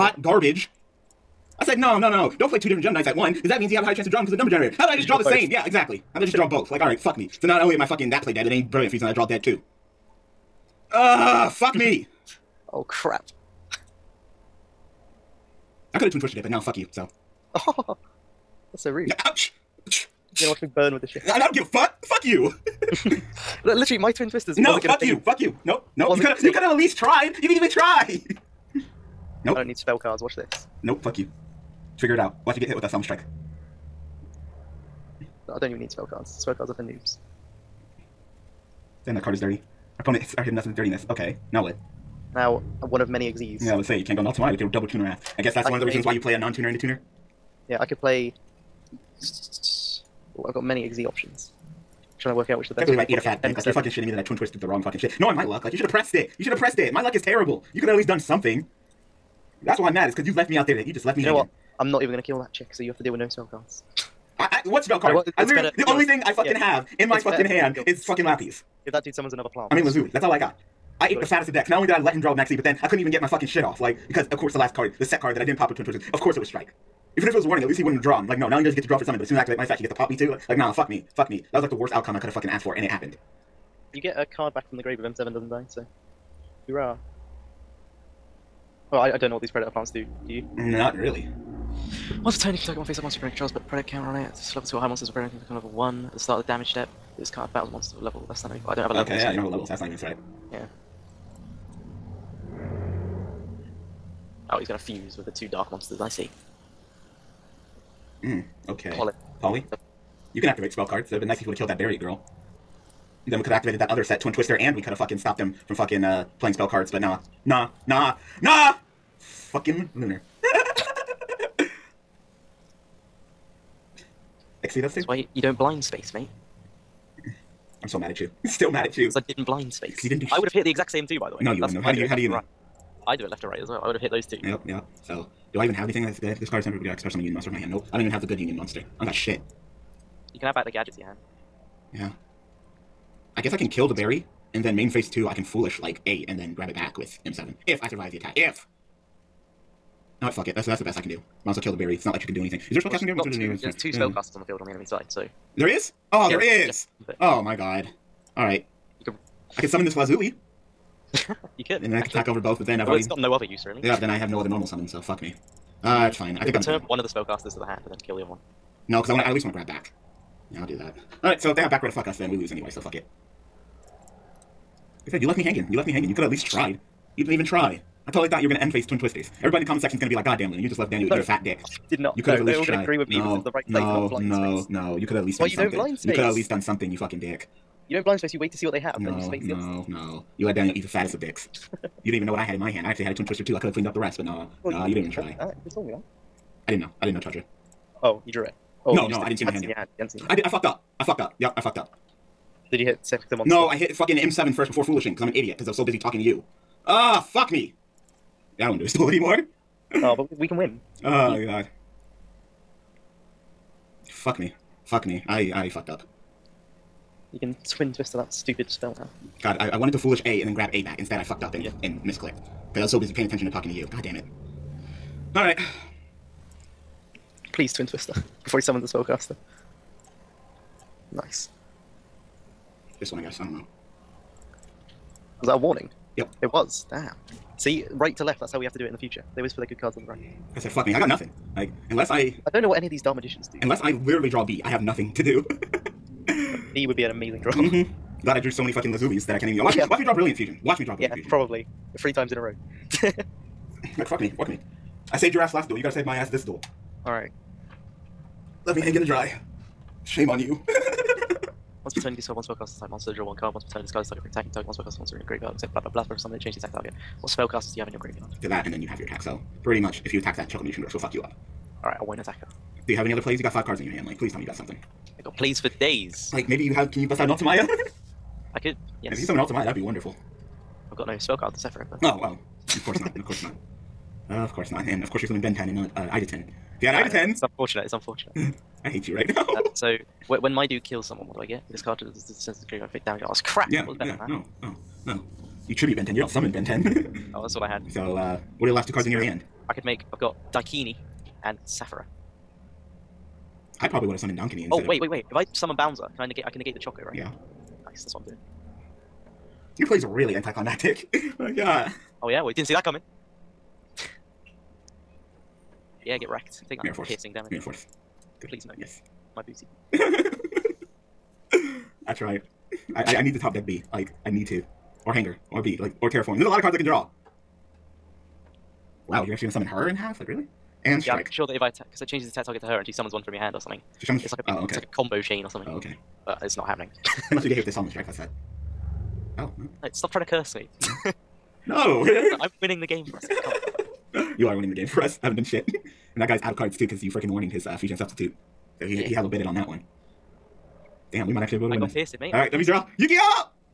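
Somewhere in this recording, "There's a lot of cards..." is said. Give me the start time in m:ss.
5:26.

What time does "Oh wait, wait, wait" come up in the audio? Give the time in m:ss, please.
5:04.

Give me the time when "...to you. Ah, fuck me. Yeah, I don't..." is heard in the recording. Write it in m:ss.
3:26.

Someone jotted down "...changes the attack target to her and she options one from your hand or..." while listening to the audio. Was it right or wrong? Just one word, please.
wrong.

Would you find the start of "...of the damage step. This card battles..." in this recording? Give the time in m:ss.
1:36.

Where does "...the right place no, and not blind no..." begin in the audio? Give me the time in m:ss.
3:03.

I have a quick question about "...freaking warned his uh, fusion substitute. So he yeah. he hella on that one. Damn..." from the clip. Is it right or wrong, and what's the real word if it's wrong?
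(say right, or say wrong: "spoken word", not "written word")
right.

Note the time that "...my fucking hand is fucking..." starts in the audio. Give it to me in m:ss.
1:07.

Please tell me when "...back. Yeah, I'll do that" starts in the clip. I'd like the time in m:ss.
2:49.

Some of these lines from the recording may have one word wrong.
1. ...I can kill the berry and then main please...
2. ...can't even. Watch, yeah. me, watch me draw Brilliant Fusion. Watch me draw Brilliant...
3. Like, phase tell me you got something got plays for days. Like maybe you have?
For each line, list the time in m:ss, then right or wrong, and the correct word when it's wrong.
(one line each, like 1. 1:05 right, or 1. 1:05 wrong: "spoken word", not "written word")
1. 2:23 wrong: "phase", not "please"
2. 4:09 right
3. 4:34 wrong: "please", not "phase".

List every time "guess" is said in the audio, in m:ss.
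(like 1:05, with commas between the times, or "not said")
0:45, 2:23, 3:53.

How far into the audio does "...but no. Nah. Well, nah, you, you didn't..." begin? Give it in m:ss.
3:14.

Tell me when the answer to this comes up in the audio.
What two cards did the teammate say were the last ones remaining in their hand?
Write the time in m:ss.
5:00.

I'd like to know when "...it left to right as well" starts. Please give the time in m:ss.
2:13.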